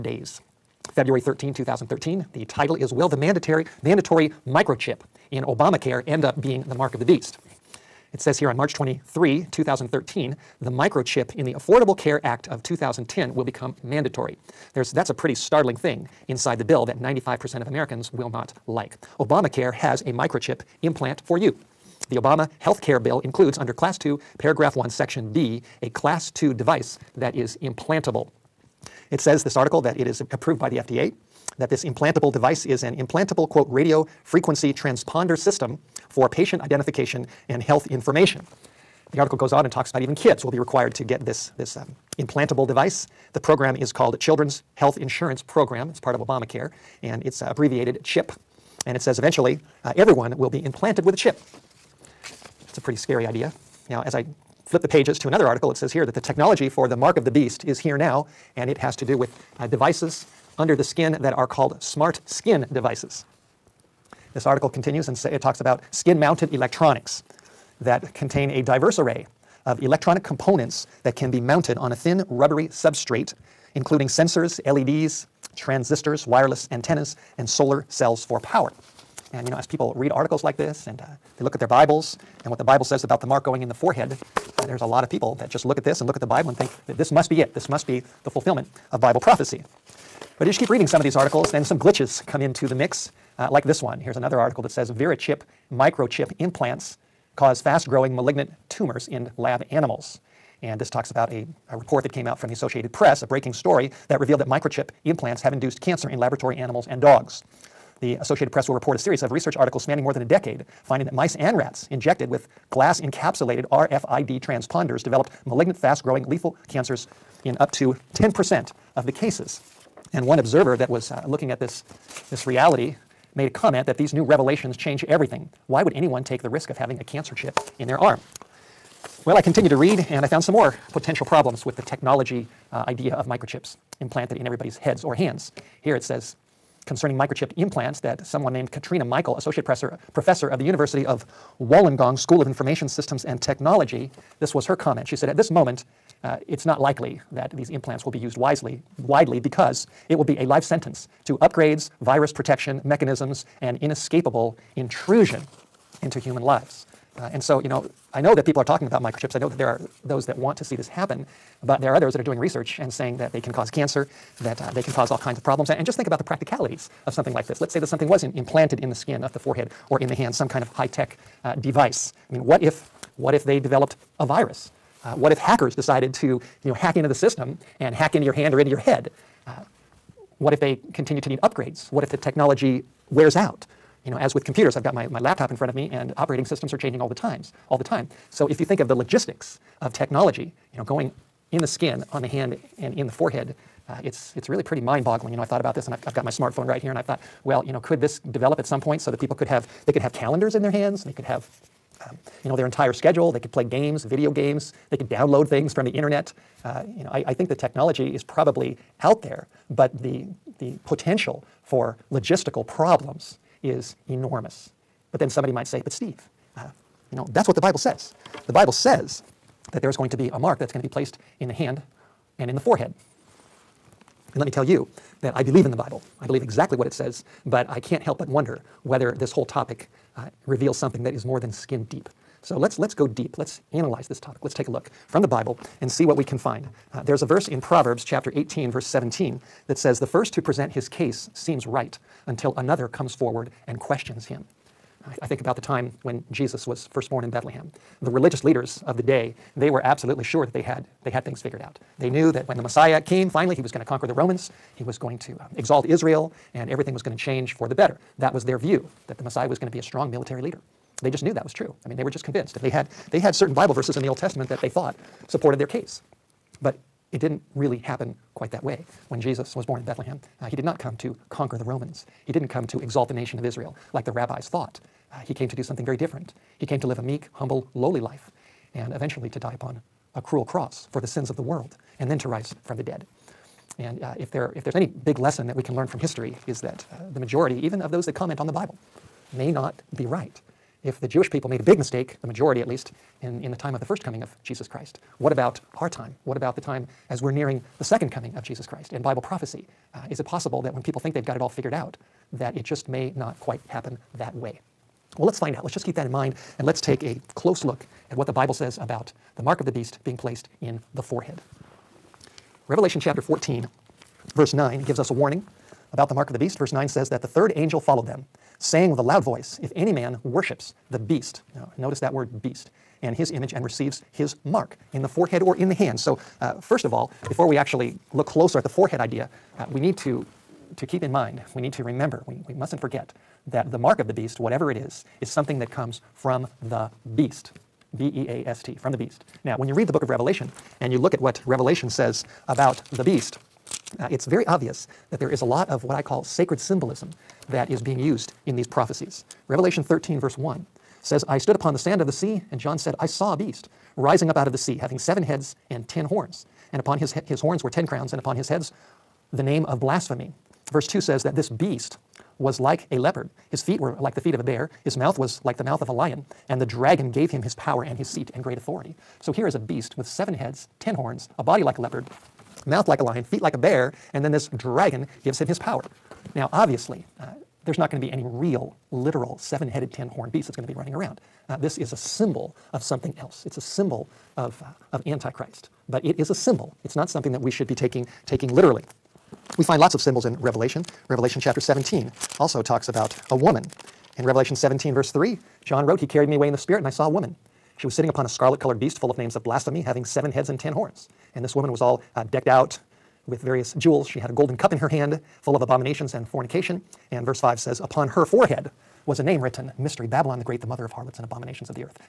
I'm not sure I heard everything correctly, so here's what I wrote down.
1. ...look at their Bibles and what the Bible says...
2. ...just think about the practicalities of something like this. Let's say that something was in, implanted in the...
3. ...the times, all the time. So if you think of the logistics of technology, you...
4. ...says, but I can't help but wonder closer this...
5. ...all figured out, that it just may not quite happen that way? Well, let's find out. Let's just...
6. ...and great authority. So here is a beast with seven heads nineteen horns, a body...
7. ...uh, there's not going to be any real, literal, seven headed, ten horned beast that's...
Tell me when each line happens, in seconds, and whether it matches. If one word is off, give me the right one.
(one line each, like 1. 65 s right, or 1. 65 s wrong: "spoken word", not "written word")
1. 81 s right
2. 165 s right
3. 187 s right
4. 226 s wrong: "whether", not "closer"
5. 301 s right
6. 368 s wrong: "ten", not "nineteen"
7. 377 s right.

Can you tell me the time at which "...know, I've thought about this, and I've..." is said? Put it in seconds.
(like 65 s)
195 s.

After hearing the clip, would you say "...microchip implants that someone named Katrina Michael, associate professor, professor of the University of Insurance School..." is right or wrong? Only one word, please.
wrong.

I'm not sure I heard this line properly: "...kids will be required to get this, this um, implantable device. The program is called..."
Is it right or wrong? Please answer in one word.
right.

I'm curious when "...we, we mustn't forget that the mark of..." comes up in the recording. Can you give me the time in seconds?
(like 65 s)
332 s.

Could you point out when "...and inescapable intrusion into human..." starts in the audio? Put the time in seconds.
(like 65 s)
153 s.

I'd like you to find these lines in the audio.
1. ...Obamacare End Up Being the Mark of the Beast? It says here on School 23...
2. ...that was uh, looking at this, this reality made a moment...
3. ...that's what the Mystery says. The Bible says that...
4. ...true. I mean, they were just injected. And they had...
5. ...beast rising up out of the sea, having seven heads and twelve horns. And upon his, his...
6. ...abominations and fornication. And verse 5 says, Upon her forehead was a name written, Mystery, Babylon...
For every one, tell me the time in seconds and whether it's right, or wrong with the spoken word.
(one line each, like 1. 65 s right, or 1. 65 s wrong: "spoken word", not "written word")
1. 5 s wrong: "March", not "School"
2. 120 s wrong: "comment", not "moment"
3. 217 s wrong: "Bible", not "Mystery"
4. 261 s wrong: "convinced", not "injected"
5. 353 s wrong: "ten", not "twelve"
6. 405 s right.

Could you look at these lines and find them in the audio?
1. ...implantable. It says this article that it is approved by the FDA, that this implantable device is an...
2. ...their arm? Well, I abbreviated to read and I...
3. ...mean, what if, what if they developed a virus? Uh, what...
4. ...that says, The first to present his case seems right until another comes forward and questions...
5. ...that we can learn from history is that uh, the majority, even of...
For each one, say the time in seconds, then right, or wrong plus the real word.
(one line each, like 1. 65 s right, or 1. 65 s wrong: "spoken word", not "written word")
1. 27 s right
2. 127 s wrong: "continued", not "abbreviated"
3. 172 s right
4. 239 s right
5. 285 s right.